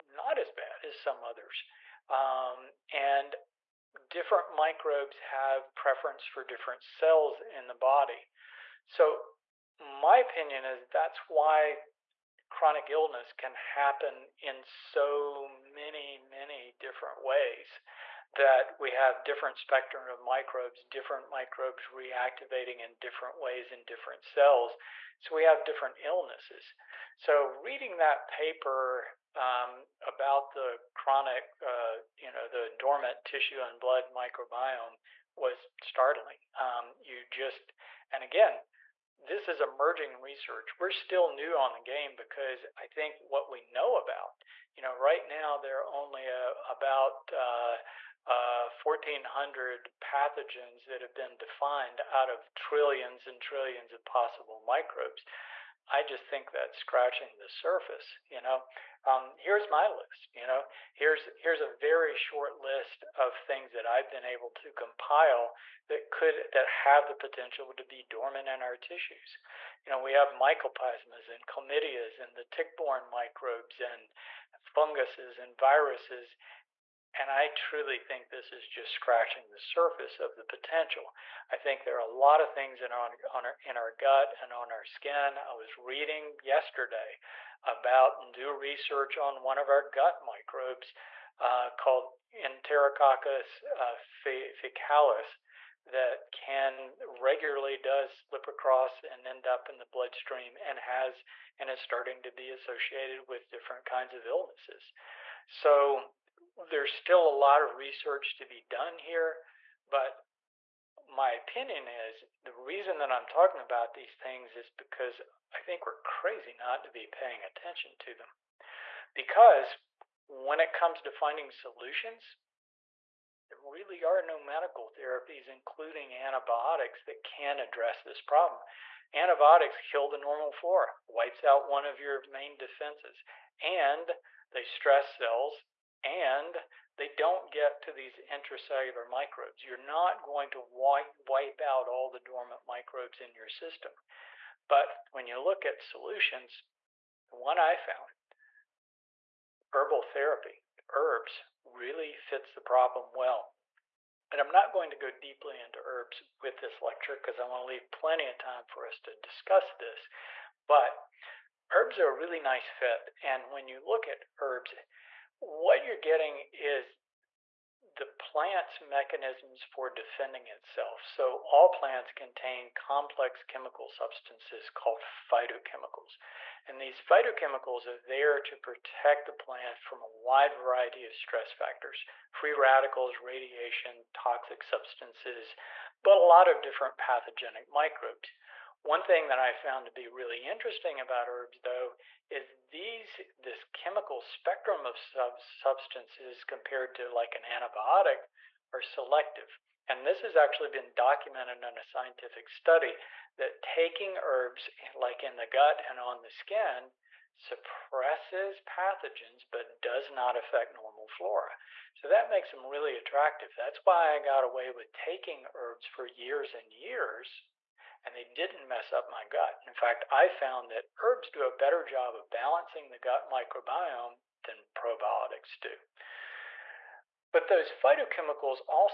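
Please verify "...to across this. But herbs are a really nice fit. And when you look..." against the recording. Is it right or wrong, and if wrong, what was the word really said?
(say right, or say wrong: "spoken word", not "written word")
wrong: "discuss", not "across".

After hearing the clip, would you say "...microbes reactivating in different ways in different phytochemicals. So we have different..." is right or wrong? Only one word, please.
wrong.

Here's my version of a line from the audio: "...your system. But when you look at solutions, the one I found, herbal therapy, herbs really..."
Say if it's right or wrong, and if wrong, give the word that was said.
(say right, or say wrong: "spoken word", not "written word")
right.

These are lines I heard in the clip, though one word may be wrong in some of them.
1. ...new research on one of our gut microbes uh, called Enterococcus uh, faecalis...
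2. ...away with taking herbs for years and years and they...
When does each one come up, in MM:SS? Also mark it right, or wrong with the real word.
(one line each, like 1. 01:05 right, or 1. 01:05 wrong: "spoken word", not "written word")
1. 01:28 right
2. 03:34 right.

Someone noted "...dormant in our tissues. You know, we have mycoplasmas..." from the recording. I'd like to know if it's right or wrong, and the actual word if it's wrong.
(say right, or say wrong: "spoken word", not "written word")
right.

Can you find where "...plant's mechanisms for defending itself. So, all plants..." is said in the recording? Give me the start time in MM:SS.
02:48.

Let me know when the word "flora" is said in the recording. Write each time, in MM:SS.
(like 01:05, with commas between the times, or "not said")
02:10, 03:31.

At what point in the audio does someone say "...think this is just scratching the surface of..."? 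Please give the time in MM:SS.
01:17.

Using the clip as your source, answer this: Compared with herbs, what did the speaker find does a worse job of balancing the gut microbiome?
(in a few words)
probiotics.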